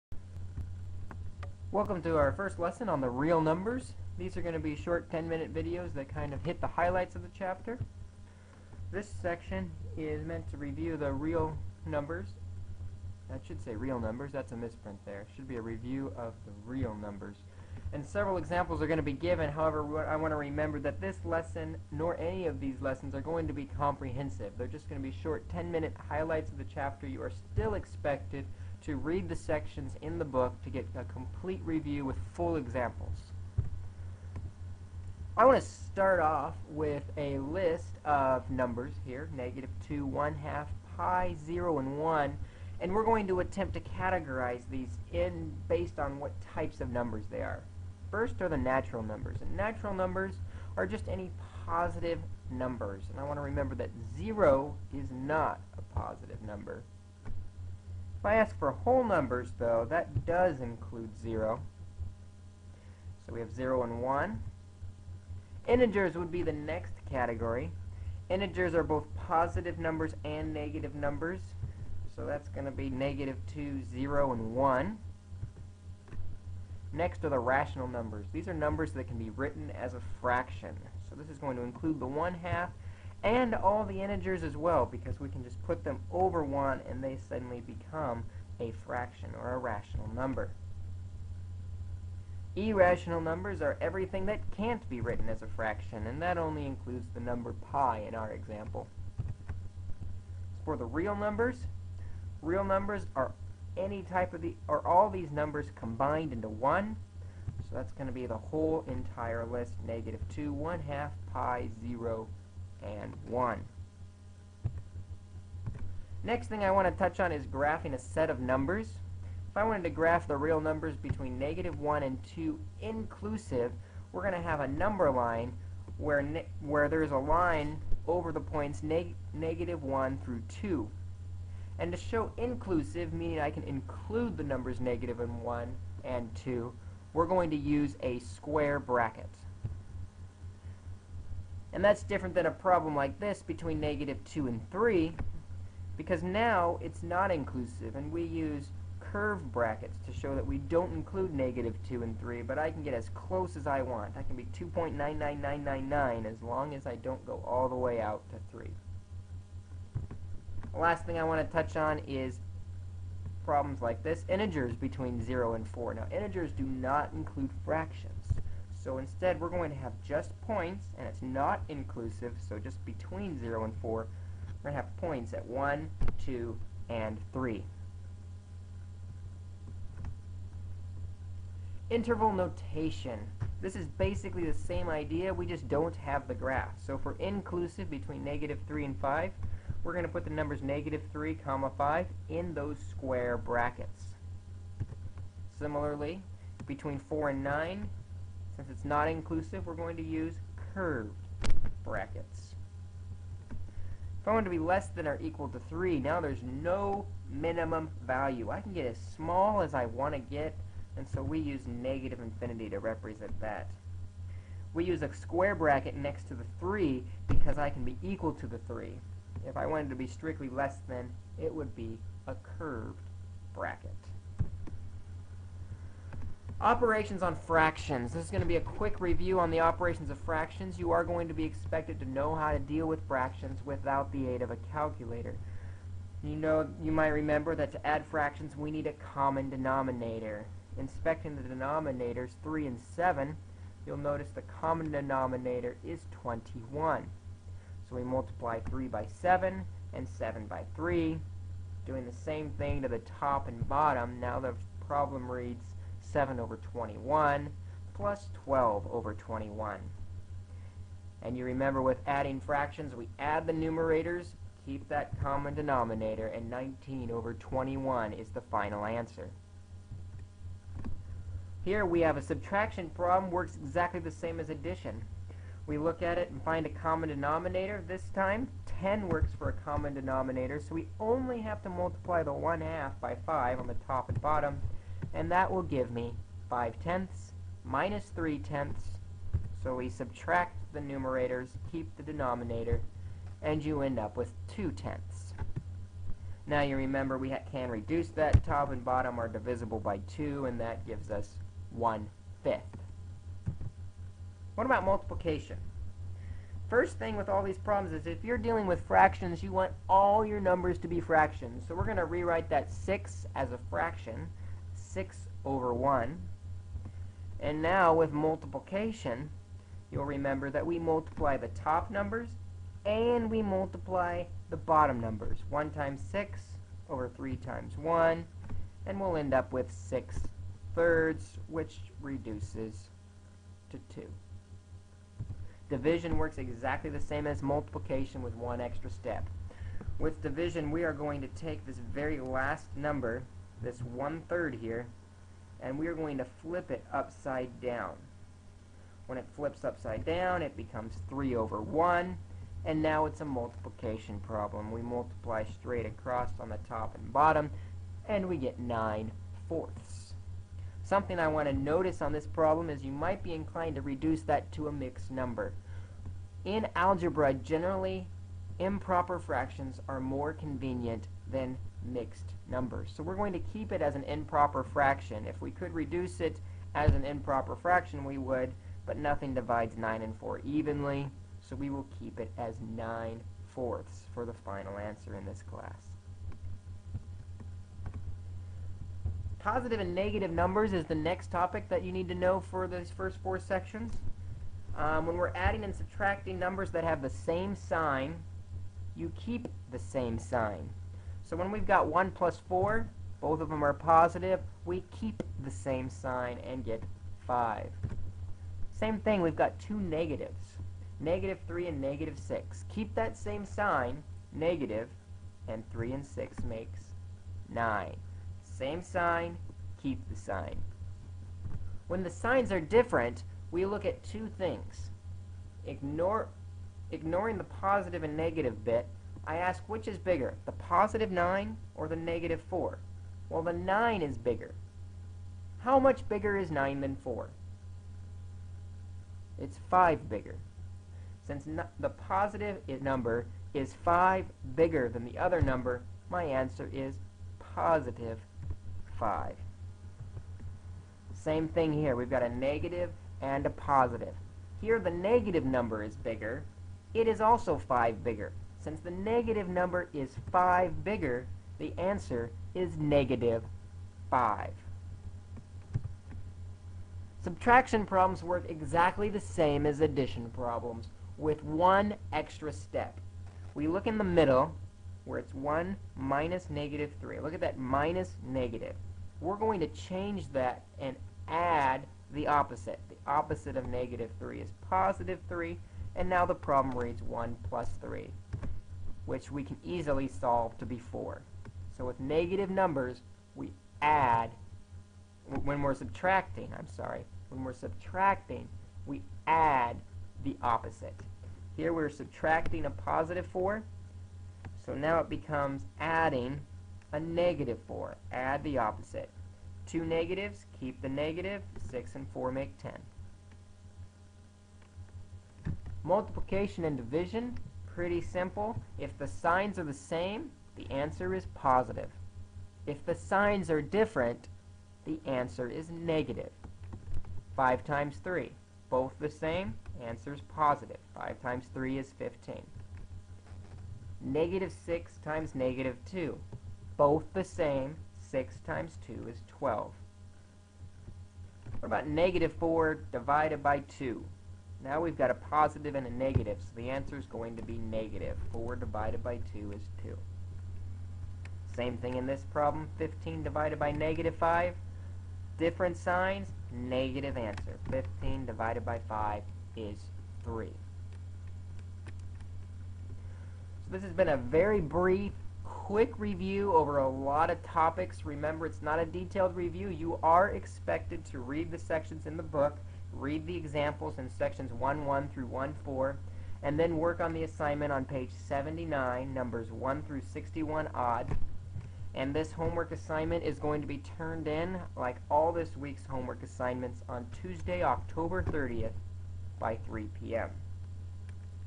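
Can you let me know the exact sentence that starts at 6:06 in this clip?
In algebra, generally, improper fractions are more convenient than mixed numbers.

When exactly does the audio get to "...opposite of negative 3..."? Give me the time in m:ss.
8:03.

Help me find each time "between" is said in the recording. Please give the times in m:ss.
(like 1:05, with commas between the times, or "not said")
2:00, 2:23, 2:44, 2:52, 3:07, 3:16.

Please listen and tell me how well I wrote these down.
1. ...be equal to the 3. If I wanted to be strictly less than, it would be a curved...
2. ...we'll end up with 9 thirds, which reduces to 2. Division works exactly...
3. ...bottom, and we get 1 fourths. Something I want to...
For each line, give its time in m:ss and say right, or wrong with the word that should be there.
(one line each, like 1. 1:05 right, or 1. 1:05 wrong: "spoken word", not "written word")
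1. 3:37 right
2. 5:28 wrong: "6", not "9"
3. 5:57 wrong: "9", not "1".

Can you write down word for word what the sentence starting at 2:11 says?
And to show inclusive, meaning I can include the numbers negative and 1 and 2, we're going to use a square bracket.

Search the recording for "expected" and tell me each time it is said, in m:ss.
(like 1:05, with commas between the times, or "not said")
0:27, 3:51, 9:30.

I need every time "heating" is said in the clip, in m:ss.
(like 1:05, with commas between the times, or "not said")
not said.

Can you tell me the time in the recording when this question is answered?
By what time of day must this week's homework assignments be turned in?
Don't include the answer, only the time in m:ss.
9:49.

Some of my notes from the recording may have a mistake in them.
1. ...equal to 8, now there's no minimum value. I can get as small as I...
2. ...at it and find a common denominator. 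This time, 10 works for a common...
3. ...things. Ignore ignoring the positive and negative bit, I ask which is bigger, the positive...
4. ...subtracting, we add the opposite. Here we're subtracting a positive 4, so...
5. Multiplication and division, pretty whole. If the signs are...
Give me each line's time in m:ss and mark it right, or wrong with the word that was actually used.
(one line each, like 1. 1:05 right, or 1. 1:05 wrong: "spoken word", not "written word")
1. 3:25 wrong: "3", not "8"
2. 4:36 right
3. 7:04 right
4. 8:17 right
5. 8:35 wrong: "simple", not "whole".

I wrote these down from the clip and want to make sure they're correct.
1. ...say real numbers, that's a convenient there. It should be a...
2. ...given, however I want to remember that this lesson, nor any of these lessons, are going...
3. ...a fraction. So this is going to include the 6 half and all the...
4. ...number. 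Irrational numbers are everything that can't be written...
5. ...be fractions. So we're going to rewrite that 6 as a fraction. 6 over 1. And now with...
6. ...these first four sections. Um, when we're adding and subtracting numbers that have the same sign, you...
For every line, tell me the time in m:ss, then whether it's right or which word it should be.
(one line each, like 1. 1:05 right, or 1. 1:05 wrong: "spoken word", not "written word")
1. 0:13 wrong: "misprint", not "convenient"
2. 0:19 right
3. 1:19 wrong: "1", not "6"
4. 1:30 right
5. 5:10 right
6. 6:32 right.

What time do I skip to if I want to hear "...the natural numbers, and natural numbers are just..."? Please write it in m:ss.
0:48.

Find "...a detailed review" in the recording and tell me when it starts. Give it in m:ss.
9:28.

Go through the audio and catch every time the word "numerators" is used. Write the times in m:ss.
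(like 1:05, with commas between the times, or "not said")
4:23, 4:50.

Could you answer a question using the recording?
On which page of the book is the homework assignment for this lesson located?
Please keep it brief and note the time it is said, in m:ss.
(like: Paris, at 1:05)
79, at 9:38.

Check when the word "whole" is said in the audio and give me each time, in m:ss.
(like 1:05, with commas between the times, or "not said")
0:58, 1:48.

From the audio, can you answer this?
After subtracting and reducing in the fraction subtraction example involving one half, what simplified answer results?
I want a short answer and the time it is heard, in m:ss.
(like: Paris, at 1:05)
1/5, at 5:01.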